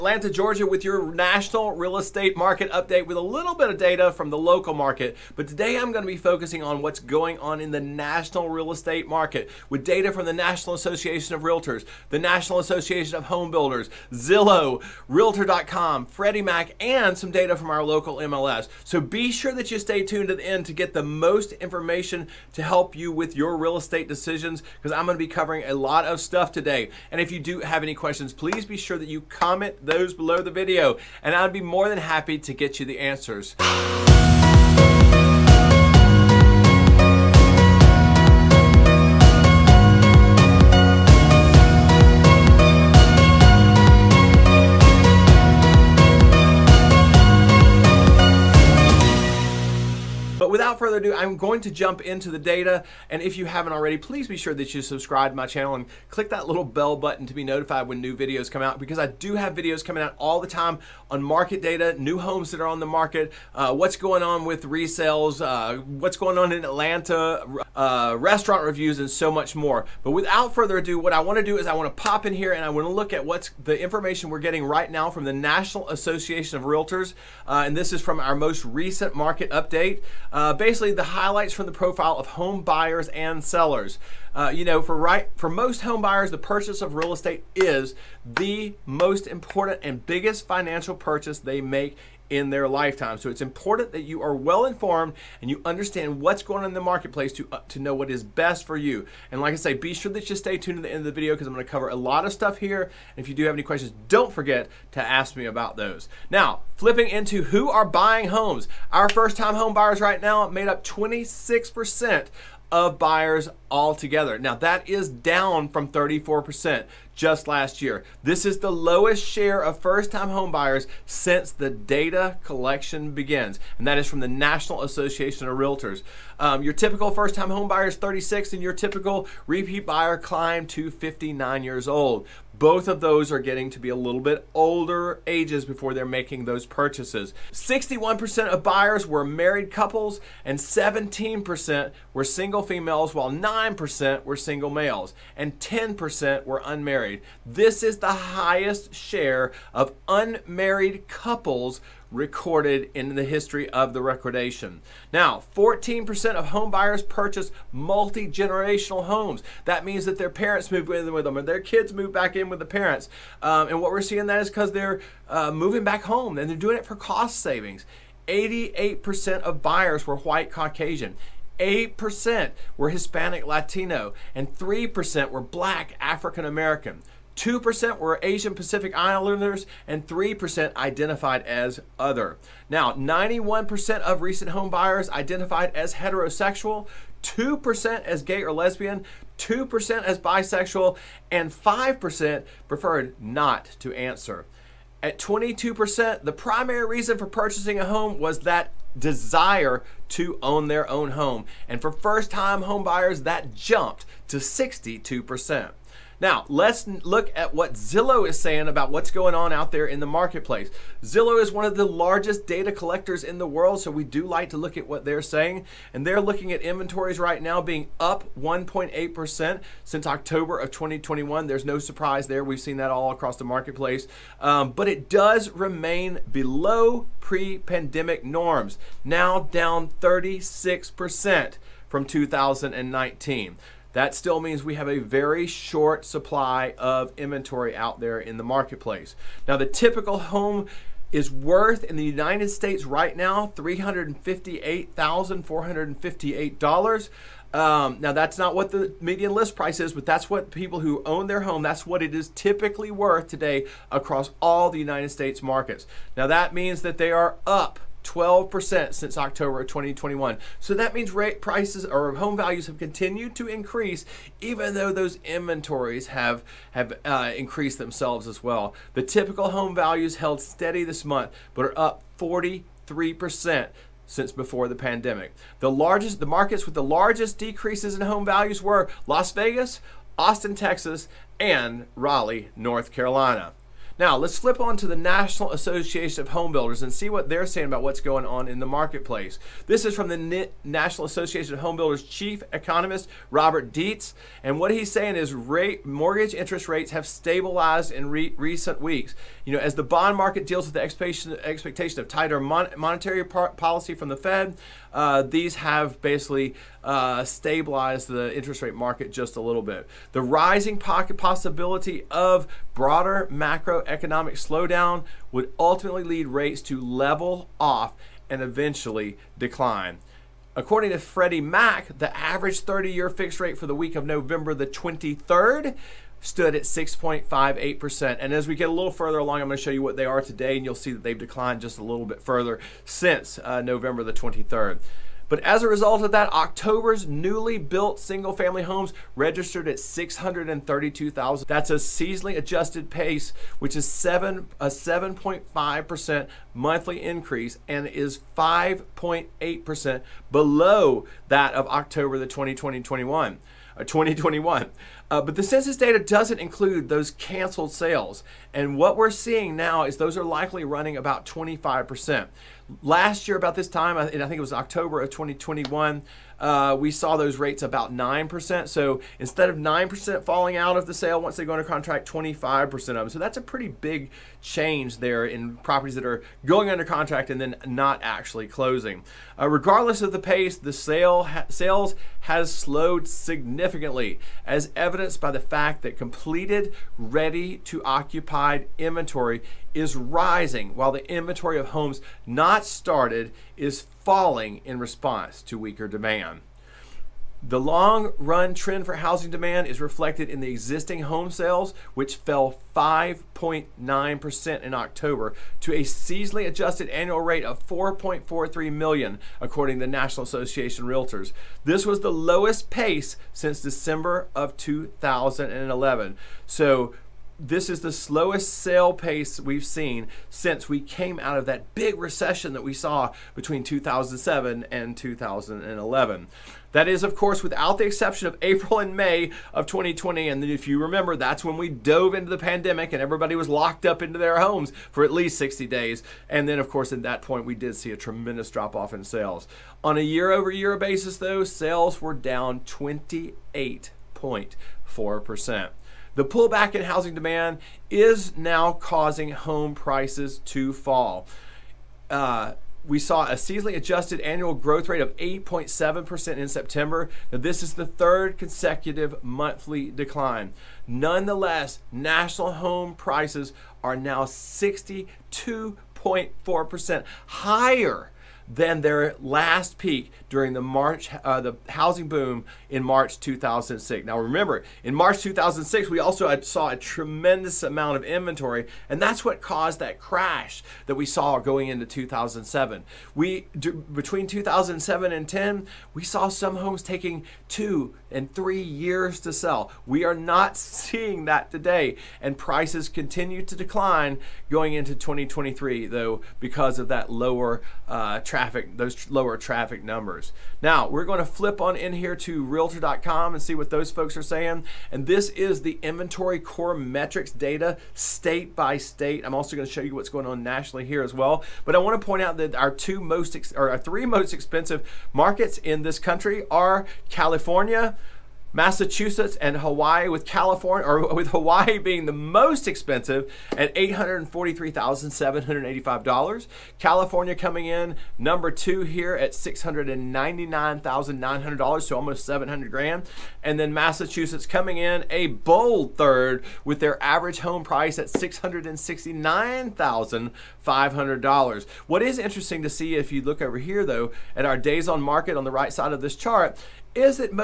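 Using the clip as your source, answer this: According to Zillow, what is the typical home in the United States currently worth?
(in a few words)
$358,458.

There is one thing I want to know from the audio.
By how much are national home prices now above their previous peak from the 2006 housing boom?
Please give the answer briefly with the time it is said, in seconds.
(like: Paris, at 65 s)
62.4%, at 464 s.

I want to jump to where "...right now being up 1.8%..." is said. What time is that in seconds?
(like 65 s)
217 s.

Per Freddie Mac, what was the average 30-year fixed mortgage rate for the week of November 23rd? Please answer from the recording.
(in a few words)
6.58%.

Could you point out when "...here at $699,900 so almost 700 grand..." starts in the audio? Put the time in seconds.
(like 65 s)
528 s.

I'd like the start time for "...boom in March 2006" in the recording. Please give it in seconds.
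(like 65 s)
472 s.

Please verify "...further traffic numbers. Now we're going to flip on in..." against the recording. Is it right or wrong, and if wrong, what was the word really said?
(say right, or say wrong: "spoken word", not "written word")
wrong: "lower", not "further".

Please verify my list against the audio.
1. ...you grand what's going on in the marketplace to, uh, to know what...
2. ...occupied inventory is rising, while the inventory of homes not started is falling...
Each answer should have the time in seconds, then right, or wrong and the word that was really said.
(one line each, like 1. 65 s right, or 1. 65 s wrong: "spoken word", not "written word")
1. 95 s wrong: "understand", not "grand"
2. 387 s right.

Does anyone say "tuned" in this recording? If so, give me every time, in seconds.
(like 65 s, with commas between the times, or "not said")
20 s, 100 s.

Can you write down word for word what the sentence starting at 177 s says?
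2% were Asian Pacific Islanders, and 3% identified as other.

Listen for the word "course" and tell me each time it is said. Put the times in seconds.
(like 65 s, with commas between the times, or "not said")
427 s, 436 s.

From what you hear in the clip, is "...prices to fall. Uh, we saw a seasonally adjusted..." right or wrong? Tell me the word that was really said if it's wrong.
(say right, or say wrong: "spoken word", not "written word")
right.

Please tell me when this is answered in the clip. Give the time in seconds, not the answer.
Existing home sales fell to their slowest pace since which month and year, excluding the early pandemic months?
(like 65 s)
413 s.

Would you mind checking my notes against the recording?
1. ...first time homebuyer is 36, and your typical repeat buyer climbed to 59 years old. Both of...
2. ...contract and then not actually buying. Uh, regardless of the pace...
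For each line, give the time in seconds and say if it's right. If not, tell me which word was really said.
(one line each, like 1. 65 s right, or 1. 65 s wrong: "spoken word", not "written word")
1. 127 s right
2. 376 s wrong: "closing", not "buying".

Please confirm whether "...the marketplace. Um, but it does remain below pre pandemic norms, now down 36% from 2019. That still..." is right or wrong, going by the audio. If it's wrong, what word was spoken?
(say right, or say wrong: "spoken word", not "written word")
right.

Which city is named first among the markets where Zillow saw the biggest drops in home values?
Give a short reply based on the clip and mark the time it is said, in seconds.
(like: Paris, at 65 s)
Las Vegas, at 279 s.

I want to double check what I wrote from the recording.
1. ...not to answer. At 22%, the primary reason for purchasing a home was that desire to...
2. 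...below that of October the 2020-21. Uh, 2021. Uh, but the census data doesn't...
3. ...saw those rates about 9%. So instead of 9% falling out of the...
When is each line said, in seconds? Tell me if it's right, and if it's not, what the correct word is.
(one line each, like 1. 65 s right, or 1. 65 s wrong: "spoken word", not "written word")
1. 193 s right
2. 350 s right
3. 366 s right.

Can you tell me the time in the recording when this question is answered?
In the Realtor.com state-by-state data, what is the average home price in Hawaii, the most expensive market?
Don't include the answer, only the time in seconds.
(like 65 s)
523 s.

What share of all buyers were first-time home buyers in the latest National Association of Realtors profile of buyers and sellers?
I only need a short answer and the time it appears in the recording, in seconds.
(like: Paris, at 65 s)
26%, at 110 s.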